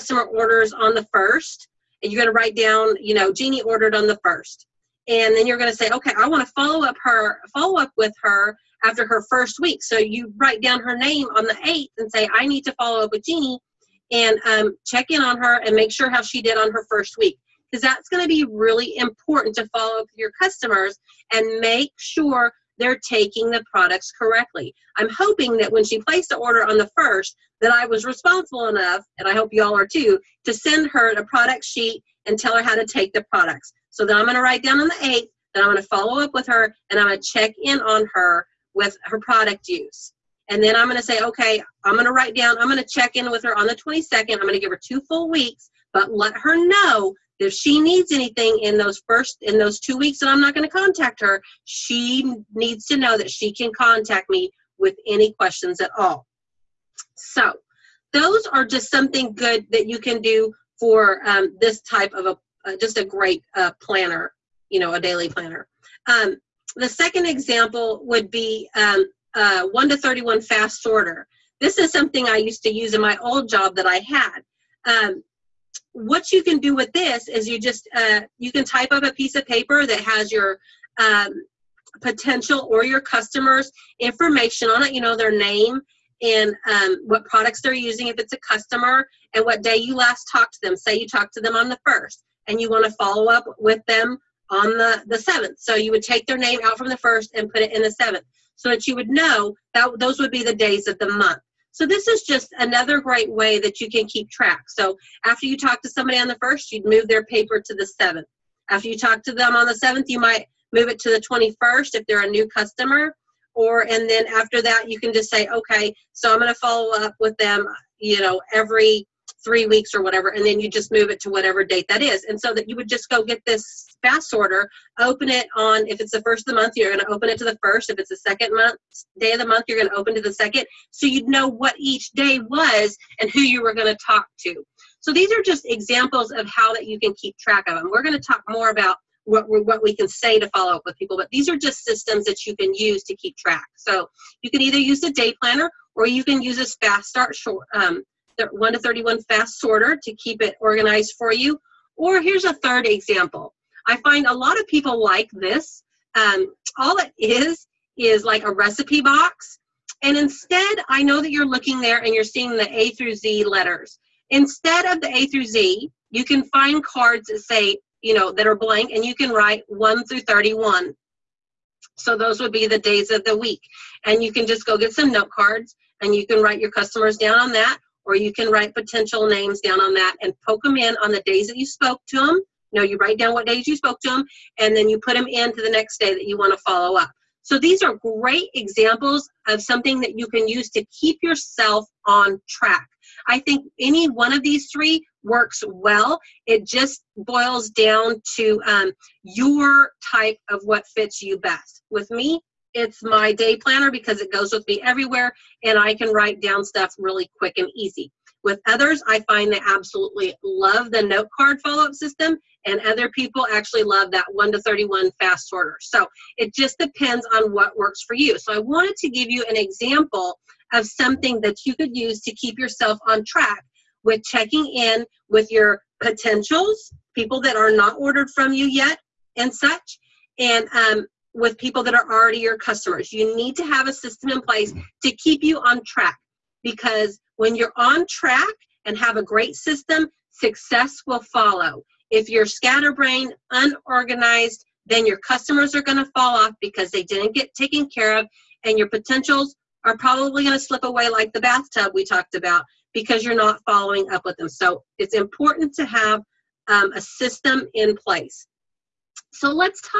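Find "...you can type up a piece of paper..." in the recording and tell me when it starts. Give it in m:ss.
1:18.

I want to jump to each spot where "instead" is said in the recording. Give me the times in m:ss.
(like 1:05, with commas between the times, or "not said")
2:40, 2:44.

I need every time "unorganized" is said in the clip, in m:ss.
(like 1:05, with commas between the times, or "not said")
4:03.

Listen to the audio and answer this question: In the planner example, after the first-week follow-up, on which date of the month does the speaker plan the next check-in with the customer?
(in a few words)
22nd.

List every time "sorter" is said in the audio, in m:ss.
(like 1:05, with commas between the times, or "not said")
1:10, 2:04, 2:29, 3:35.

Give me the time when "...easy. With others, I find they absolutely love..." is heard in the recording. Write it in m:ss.
3:27.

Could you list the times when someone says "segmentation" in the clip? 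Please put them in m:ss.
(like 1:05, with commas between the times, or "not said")
not said.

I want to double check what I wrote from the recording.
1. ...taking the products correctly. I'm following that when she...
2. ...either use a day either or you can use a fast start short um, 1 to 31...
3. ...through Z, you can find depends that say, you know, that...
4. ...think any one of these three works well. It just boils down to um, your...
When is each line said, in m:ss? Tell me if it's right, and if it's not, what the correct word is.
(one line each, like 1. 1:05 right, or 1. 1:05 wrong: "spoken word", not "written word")
1. 0:23 wrong: "hoping", not "following"
2. 2:24 wrong: "planner", not "either"
3. 2:45 wrong: "cards", not "depends"
4. 3:13 right.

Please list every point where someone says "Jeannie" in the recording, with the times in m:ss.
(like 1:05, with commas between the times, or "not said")
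0:03, 0:13.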